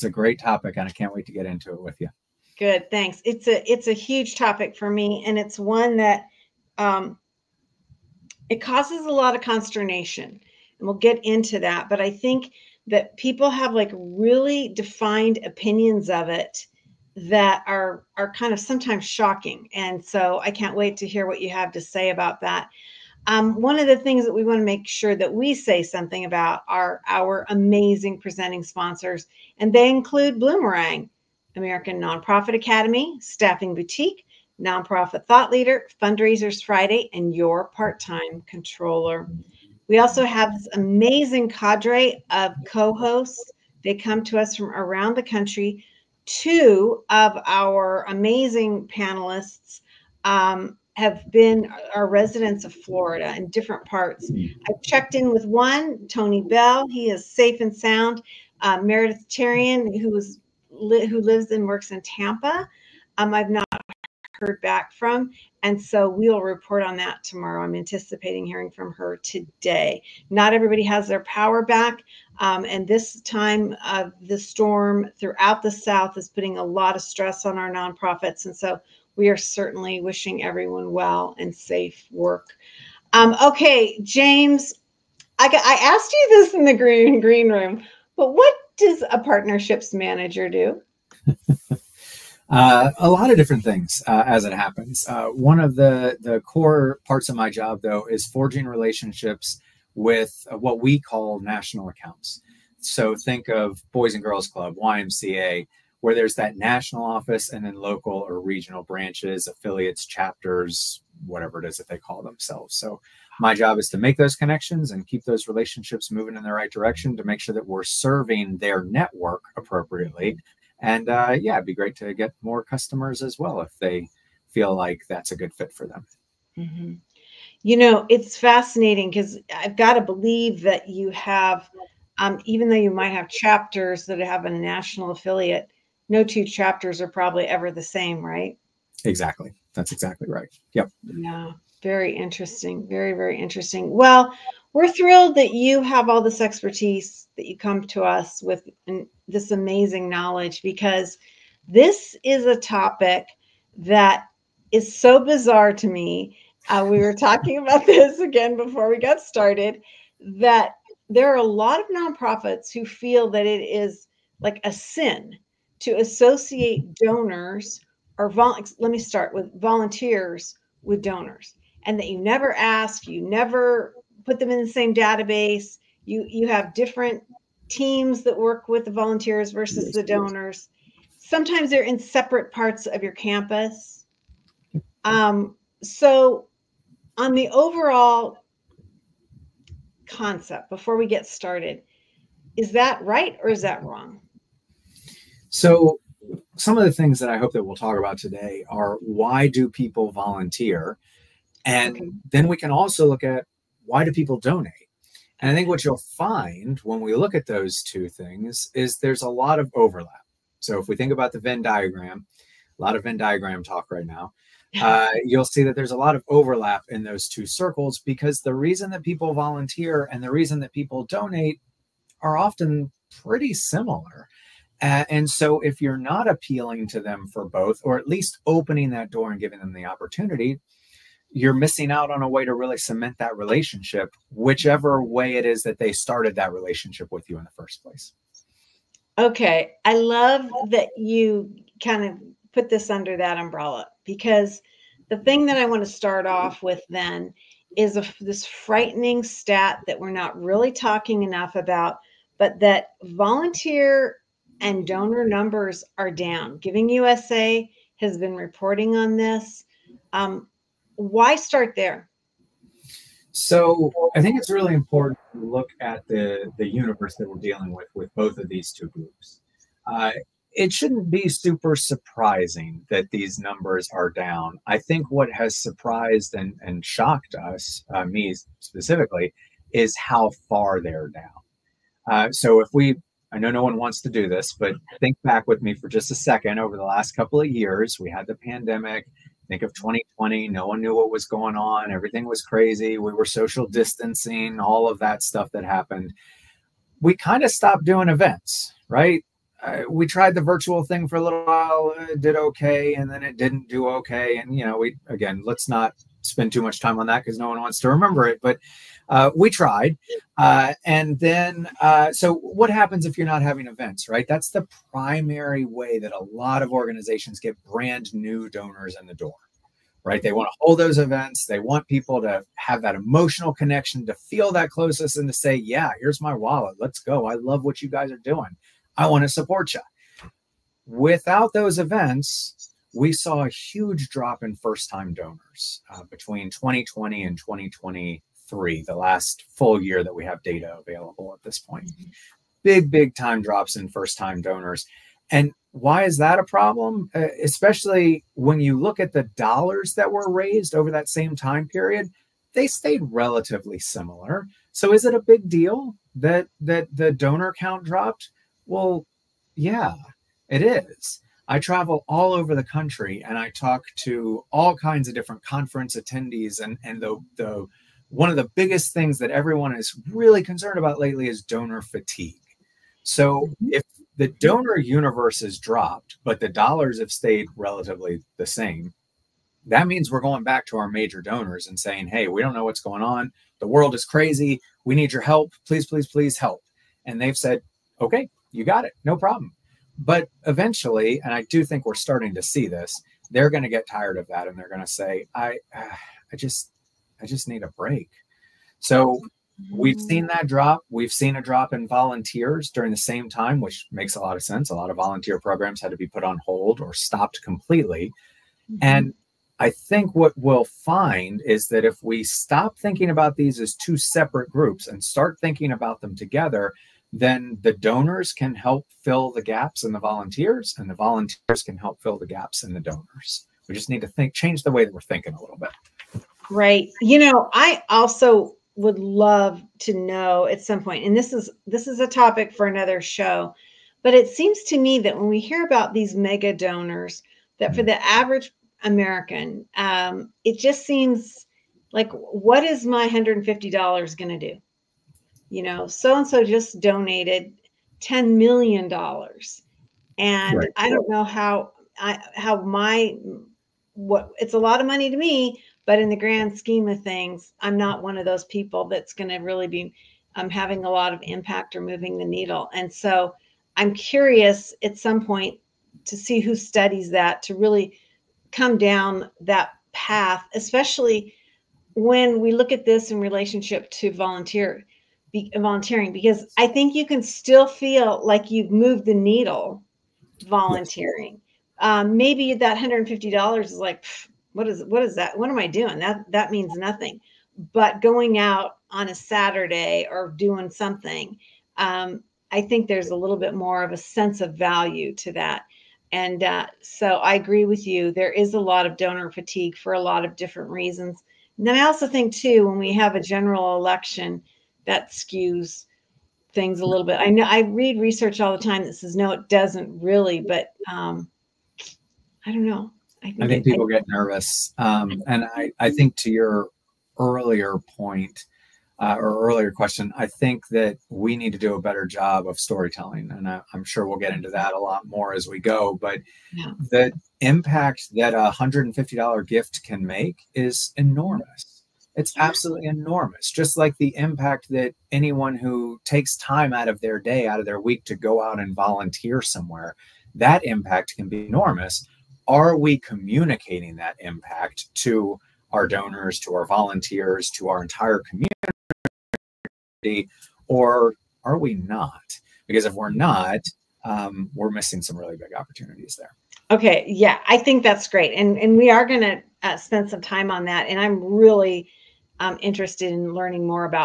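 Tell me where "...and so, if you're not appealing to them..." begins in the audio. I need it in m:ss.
3:44.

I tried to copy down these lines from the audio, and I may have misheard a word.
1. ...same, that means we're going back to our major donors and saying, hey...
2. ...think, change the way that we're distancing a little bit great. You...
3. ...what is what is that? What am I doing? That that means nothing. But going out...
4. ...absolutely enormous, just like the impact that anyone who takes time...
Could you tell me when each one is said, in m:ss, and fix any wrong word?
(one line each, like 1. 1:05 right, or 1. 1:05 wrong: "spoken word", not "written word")
1. 6:18 right
2. 7:04 wrong: "thinking", not "distancing"
3. 8:04 right
4. 8:52 right.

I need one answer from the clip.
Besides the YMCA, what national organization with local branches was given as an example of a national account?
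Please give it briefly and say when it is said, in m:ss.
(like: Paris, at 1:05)
Boys and Girls Club, at 1:43.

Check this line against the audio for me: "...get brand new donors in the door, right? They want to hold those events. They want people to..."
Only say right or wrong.
right.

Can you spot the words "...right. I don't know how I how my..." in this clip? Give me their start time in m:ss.
7:30.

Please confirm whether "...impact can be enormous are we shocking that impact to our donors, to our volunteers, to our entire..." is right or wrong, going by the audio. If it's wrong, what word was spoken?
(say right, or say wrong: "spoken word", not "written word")
wrong: "communicating", not "shocking".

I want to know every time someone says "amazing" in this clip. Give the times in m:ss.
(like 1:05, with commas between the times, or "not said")
0:27, 0:40, 0:48, 2:29.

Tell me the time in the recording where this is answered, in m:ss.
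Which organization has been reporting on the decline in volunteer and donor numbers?
4:16.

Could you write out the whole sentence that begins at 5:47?
Uh, especially when you look at the dollars that were raised over that same time period, they stayed relatively similar.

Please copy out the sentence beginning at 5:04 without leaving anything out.
And, you know, we, again, let's not spend too much time on that because no one wants to remember it.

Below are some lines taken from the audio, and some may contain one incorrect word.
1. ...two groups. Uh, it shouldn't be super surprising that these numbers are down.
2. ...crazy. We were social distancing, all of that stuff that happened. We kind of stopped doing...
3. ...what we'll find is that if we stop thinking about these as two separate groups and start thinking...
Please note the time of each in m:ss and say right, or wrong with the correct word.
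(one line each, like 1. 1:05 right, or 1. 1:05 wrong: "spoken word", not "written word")
1. 4:28 right
2. 4:52 right
3. 6:50 right.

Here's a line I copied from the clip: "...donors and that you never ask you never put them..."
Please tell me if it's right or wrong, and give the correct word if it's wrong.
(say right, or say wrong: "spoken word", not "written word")
right.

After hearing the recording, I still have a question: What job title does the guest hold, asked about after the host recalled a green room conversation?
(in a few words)
Partnerships manager.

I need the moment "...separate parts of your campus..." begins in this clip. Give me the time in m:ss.
3:01.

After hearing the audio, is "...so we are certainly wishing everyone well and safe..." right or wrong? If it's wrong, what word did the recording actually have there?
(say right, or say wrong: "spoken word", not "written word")
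right.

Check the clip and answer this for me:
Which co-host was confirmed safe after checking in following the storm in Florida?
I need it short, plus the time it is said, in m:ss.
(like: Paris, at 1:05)
Tony Bell, at 0:56.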